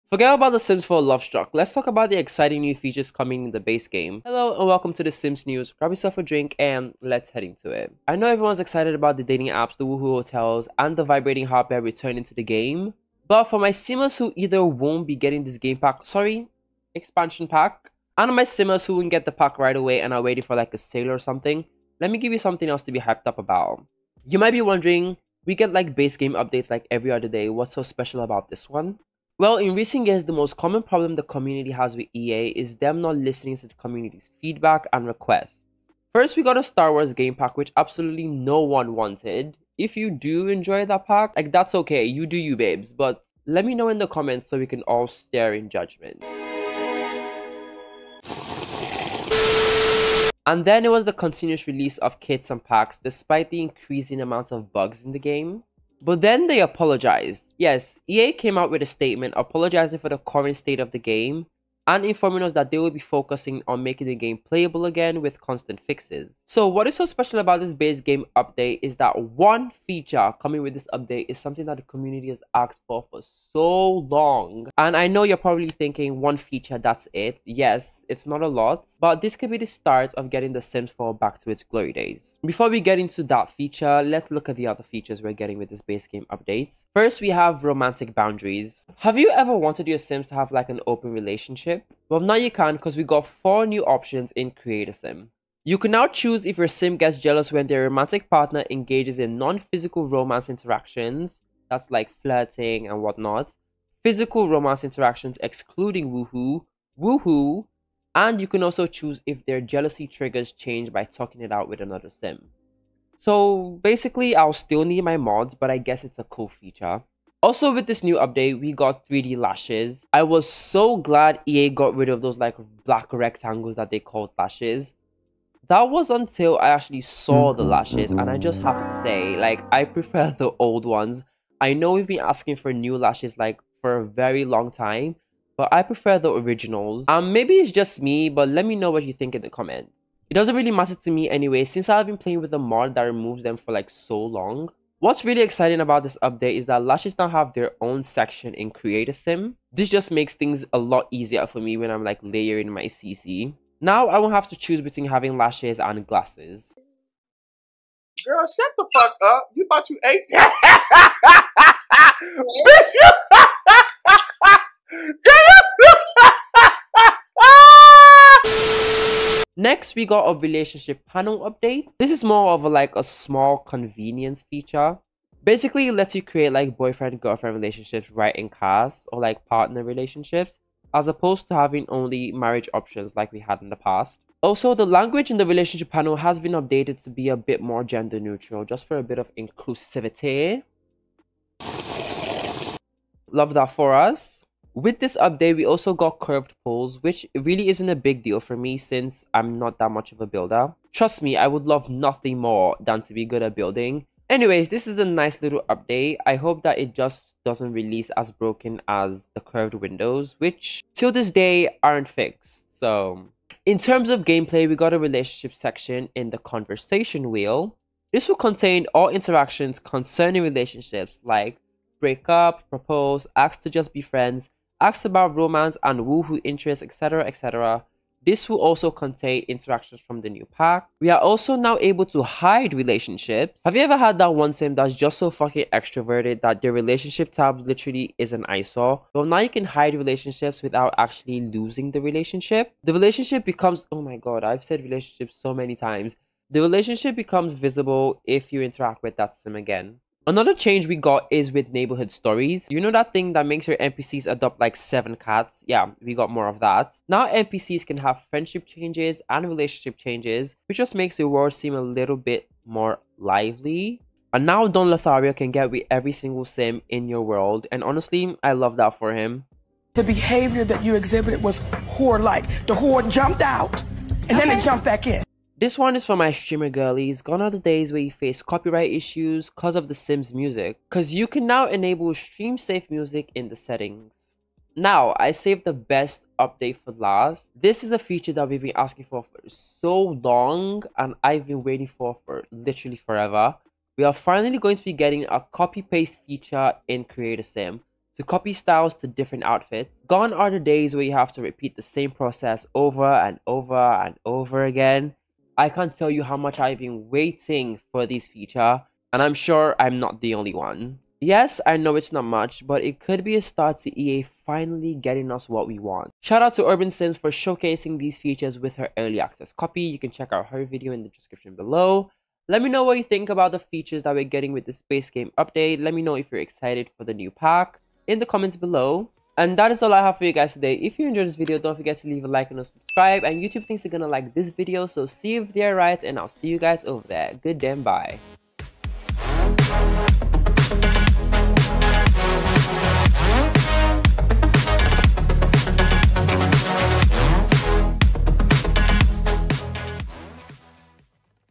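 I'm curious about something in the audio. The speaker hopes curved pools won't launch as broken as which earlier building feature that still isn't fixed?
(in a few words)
curved windows.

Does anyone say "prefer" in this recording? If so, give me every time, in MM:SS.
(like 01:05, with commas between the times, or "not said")
02:09, 02:15.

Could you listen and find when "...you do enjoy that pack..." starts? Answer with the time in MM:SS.
00:39.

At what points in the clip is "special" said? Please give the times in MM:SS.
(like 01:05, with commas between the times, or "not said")
00:27, 01:07.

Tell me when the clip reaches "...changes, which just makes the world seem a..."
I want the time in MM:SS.
04:19.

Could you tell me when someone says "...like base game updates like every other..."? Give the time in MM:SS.
00:25.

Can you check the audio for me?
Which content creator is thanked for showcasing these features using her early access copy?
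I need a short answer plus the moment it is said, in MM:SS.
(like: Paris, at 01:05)
Urban Sims, at 05:16.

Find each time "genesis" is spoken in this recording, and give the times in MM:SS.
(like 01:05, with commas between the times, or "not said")
not said.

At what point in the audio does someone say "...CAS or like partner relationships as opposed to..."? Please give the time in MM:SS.
02:58.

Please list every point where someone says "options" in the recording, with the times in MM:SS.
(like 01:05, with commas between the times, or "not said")
01:33, 03:02.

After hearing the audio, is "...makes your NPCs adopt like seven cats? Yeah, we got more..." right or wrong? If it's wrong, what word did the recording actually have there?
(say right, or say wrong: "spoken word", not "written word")
right.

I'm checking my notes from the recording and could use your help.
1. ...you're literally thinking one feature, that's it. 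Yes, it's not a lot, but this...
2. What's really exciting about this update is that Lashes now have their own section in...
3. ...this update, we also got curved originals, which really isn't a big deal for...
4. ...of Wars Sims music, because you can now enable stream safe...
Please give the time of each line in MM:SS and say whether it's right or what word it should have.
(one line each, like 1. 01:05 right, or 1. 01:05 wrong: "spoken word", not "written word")
1. 01:15 wrong: "probably", not "literally"
2. 02:25 right
3. 03:14 wrong: "pools", not "originals"
4. 04:39 wrong: "The", not "Wars".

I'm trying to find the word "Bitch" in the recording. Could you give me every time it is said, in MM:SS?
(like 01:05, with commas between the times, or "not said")
02:42.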